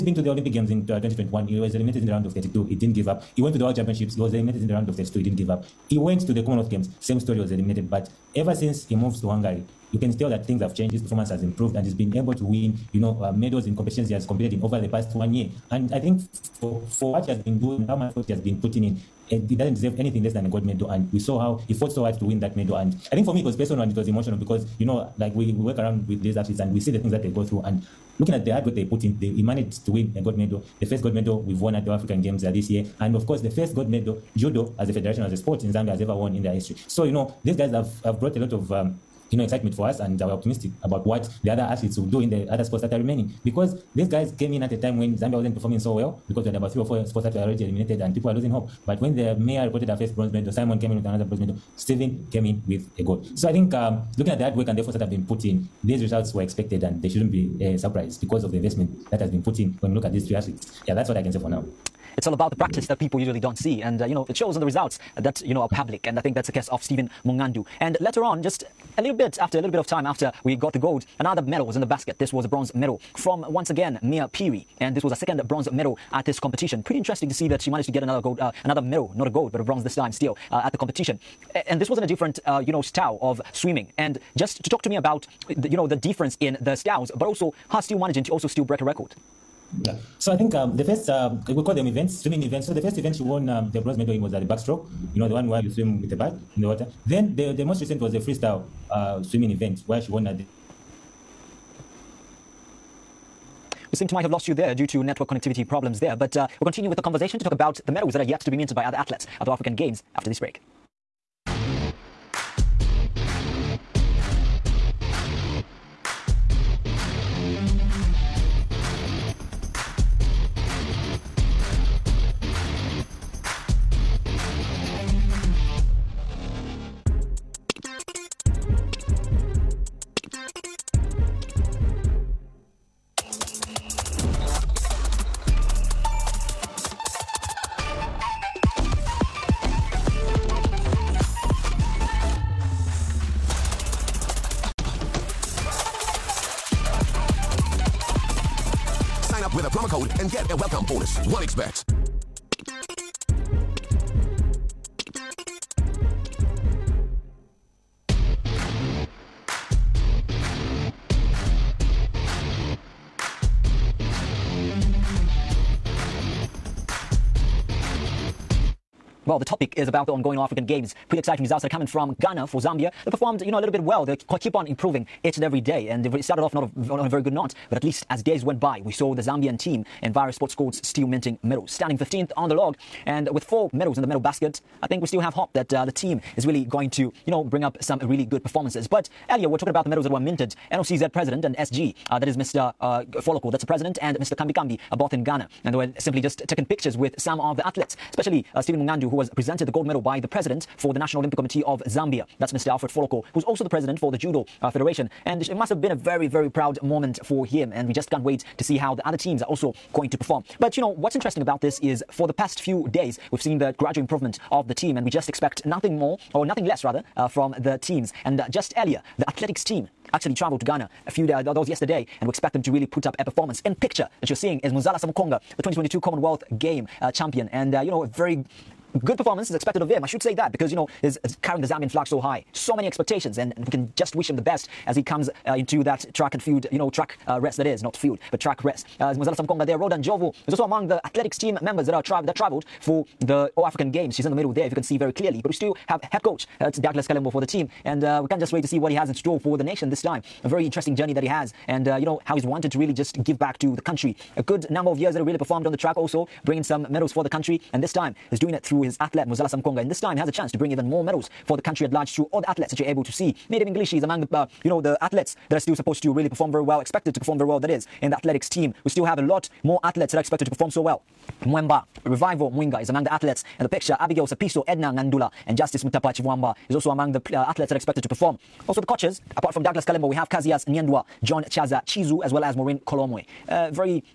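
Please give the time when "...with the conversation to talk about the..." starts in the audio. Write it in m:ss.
1:46.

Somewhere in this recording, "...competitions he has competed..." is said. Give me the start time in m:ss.
0:13.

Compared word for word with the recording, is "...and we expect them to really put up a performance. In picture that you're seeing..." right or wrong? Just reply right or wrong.
right.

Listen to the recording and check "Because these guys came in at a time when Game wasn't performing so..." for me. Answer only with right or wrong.
wrong.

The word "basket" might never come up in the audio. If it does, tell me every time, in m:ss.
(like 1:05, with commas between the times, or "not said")
1:11, 3:04.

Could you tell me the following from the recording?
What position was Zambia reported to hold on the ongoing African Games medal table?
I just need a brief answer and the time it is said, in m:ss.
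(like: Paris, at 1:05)
15th, at 3:01.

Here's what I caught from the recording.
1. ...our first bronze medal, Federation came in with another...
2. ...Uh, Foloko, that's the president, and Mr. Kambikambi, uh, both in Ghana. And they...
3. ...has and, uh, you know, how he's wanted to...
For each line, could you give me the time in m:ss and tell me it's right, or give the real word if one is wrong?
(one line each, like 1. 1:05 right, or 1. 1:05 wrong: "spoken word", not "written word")
1. 0:49 wrong: "Simon", not "Federation"
2. 3:12 right
3. 4:11 right.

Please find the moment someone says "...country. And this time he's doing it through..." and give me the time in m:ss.
4:17.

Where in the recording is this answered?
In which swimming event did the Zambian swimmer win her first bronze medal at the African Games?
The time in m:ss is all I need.
1:34.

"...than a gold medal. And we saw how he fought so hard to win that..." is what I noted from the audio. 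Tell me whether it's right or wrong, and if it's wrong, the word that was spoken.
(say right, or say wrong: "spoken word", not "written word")
right.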